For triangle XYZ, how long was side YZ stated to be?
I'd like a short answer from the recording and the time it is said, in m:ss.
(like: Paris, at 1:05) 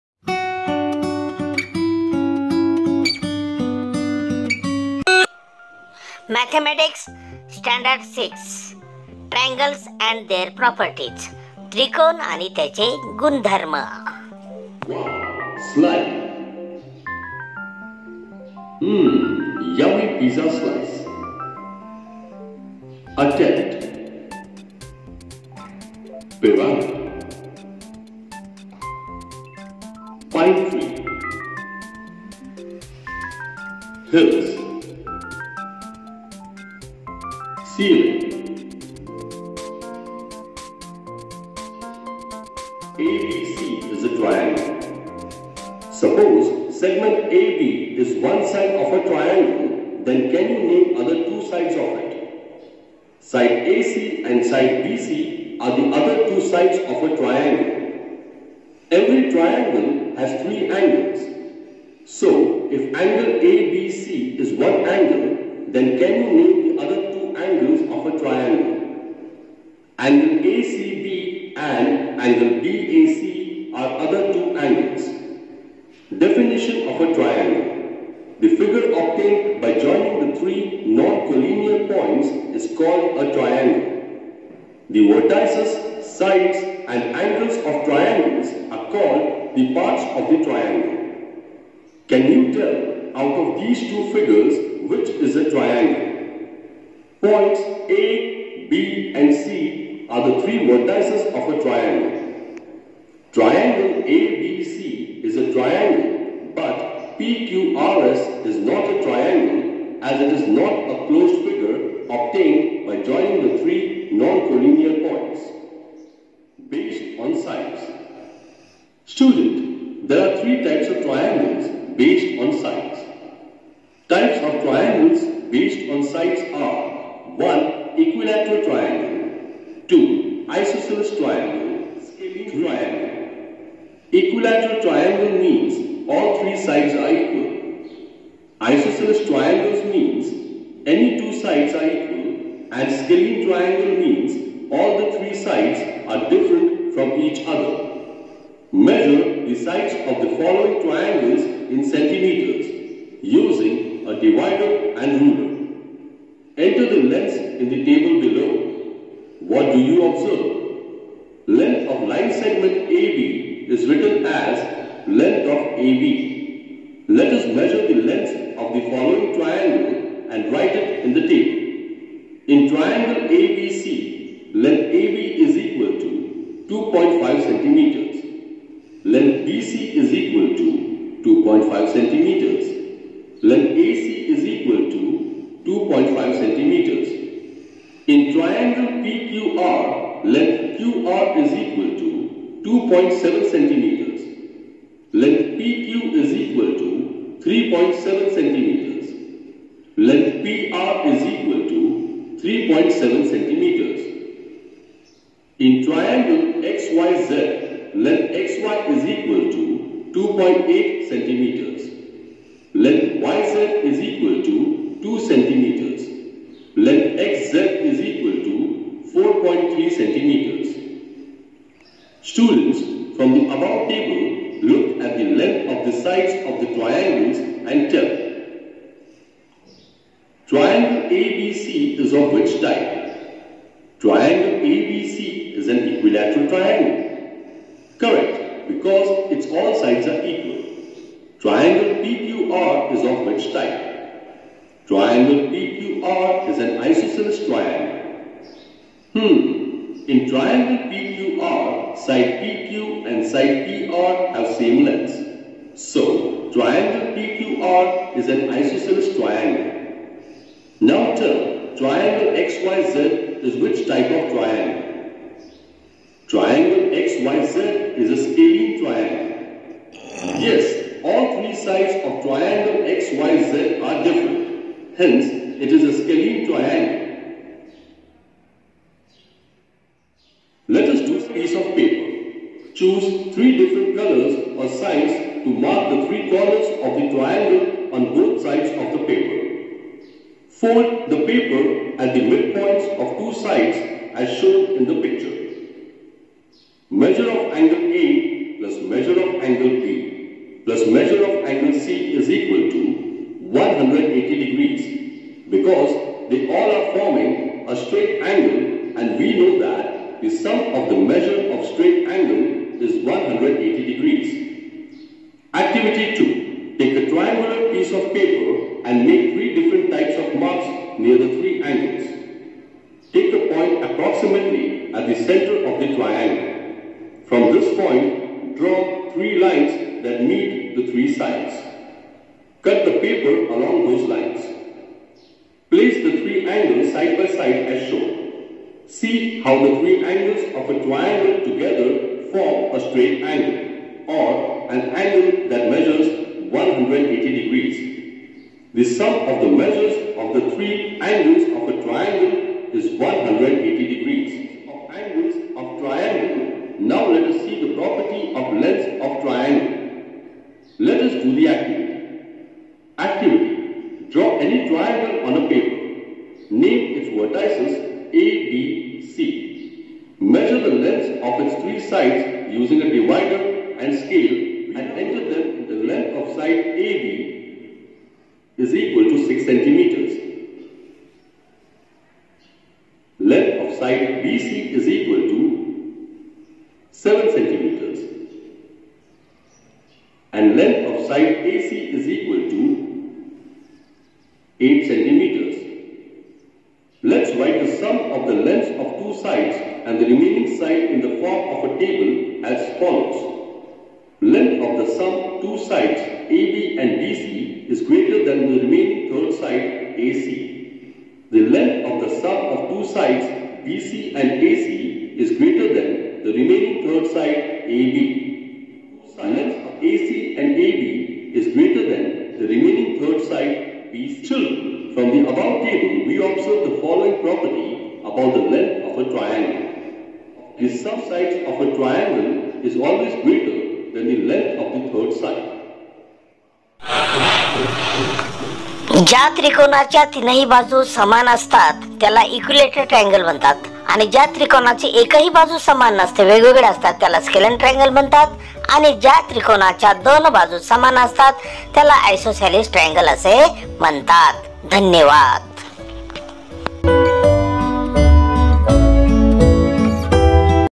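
2 centimeters, at 3:35.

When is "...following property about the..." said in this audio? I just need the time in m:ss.
7:06.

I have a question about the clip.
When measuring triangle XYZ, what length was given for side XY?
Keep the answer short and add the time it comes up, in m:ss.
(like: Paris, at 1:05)
2.8 centimeters, at 3:30.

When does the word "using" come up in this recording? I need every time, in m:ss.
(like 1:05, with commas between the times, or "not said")
2:33, 6:12.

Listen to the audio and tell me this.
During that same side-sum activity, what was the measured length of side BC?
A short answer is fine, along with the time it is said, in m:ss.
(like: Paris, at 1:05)
7 centimeters, at 6:26.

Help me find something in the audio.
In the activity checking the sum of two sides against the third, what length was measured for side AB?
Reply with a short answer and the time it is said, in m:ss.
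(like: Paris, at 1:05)
6 centimeters, at 6:19.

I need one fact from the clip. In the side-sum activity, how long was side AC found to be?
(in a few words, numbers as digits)
8 centimeters.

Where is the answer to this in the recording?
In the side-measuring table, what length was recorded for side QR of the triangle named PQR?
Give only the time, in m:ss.
3:12.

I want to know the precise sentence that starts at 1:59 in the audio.
Student, there are three types of triangles based on sides.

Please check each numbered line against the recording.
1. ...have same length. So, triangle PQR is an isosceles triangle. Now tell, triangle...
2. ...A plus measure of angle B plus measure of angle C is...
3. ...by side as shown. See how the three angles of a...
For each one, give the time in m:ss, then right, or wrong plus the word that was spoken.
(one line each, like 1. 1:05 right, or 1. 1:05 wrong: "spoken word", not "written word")
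1. 4:14 right
2. 4:57 right
3. 5:37 right.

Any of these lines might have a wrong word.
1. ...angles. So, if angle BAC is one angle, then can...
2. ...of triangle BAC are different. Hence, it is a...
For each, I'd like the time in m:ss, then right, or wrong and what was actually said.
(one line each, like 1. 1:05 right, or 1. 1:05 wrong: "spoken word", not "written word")
1. 1:00 wrong: "ABC", not "BAC"
2. 4:32 wrong: "XYZ", not "BAC".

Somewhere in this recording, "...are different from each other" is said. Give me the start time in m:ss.
2:26.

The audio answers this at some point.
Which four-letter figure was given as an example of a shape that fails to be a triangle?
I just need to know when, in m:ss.
1:47.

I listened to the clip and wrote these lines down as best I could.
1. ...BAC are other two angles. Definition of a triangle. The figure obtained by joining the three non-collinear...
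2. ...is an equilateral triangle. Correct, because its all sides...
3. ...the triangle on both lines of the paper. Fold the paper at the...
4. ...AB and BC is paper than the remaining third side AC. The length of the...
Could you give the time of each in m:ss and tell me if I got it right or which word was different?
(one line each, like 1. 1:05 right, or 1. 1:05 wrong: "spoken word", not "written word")
1. 1:12 right
2. 3:55 right
3. 4:46 wrong: "sides", not "lines"
4. 6:45 wrong: "greater", not "paper".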